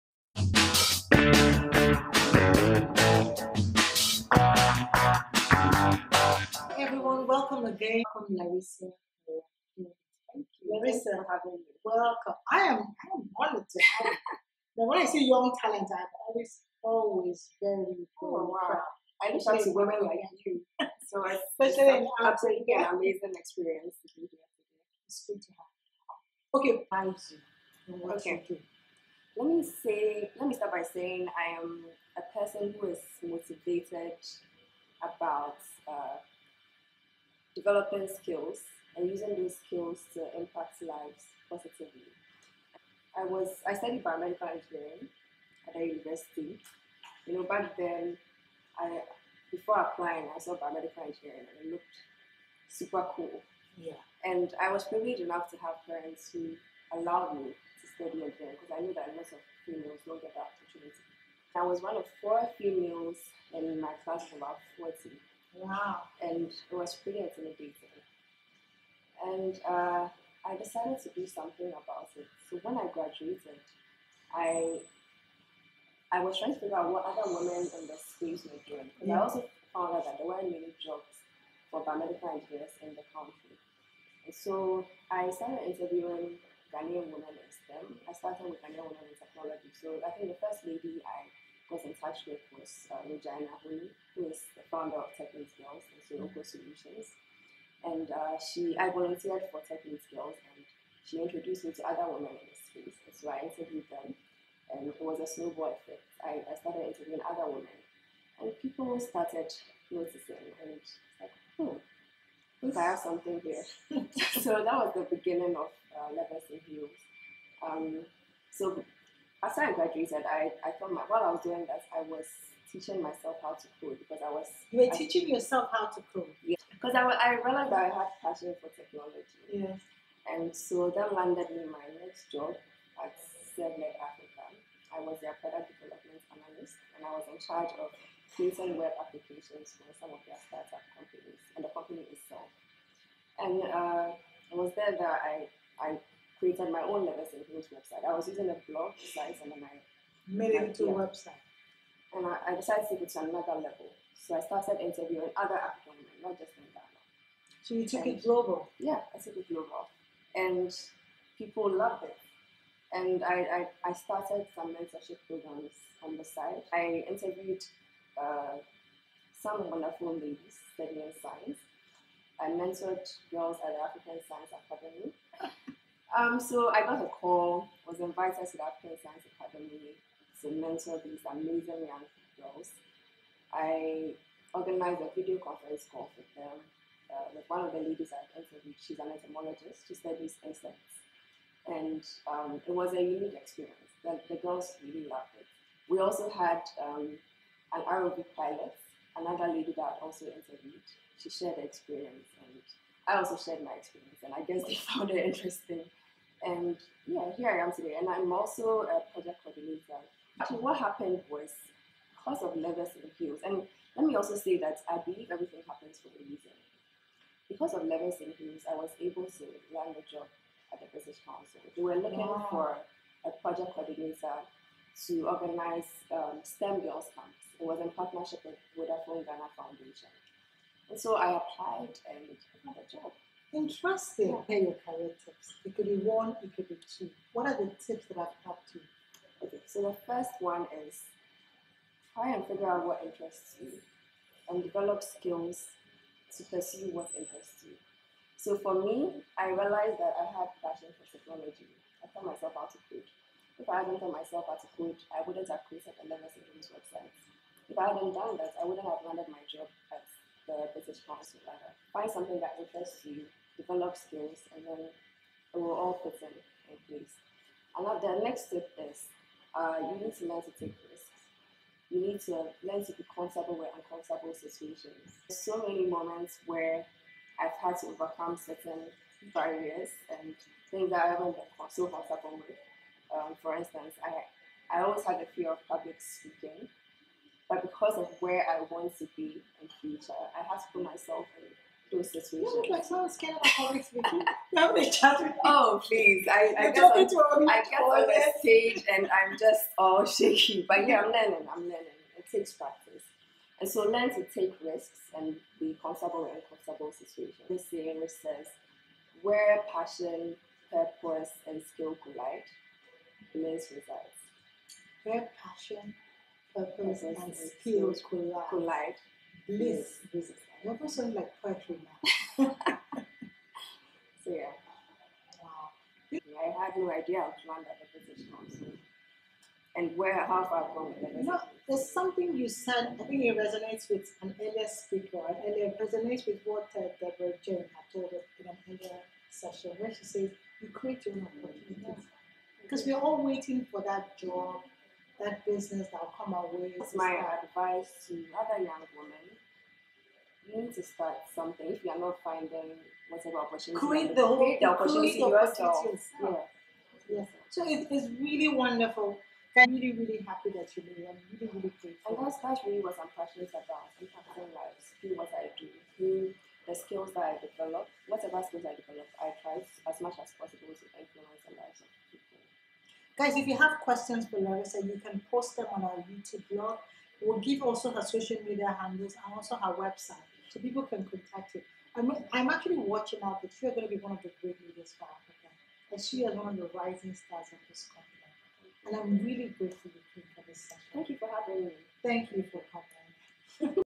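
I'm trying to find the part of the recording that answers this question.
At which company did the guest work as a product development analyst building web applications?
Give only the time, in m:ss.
2:13.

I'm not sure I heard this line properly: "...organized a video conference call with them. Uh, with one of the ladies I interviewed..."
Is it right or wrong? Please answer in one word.
right.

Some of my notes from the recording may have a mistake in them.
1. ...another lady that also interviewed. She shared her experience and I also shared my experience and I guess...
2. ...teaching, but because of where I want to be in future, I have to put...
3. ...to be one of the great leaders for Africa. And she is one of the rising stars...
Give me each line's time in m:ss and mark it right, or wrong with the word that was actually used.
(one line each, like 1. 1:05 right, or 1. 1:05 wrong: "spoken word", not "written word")
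1. 3:19 right
2. 4:45 wrong: "speaking", not "teaching"
3. 6:23 right.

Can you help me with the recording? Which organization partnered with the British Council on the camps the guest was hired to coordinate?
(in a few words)
Vodafone Ghana Foundation.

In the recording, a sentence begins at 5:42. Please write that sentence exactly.
Because we're all waiting for that job, that business that'll come our way.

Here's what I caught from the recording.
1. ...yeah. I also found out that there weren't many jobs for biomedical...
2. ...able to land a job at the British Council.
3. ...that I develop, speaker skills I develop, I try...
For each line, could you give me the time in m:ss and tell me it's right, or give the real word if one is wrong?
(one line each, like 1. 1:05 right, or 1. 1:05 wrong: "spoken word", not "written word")
1. 1:19 right
2. 3:38 right
3. 6:07 wrong: "whatever", not "speaker".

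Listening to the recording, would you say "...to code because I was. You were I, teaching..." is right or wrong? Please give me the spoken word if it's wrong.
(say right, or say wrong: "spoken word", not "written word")
right.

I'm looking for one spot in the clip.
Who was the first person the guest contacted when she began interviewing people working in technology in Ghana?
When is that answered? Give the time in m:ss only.
1:33.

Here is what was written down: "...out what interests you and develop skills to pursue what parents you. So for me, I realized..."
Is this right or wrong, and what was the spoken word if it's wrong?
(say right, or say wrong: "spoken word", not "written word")
wrong: "interests", not "parents".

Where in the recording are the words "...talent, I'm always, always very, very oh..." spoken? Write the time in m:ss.
0:15.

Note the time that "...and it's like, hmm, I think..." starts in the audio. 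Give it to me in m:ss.
1:50.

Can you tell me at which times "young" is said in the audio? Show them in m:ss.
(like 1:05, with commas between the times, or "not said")
0:15, 3:01, 5:48.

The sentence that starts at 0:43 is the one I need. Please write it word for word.
I was I studied biomedical engineering at a university.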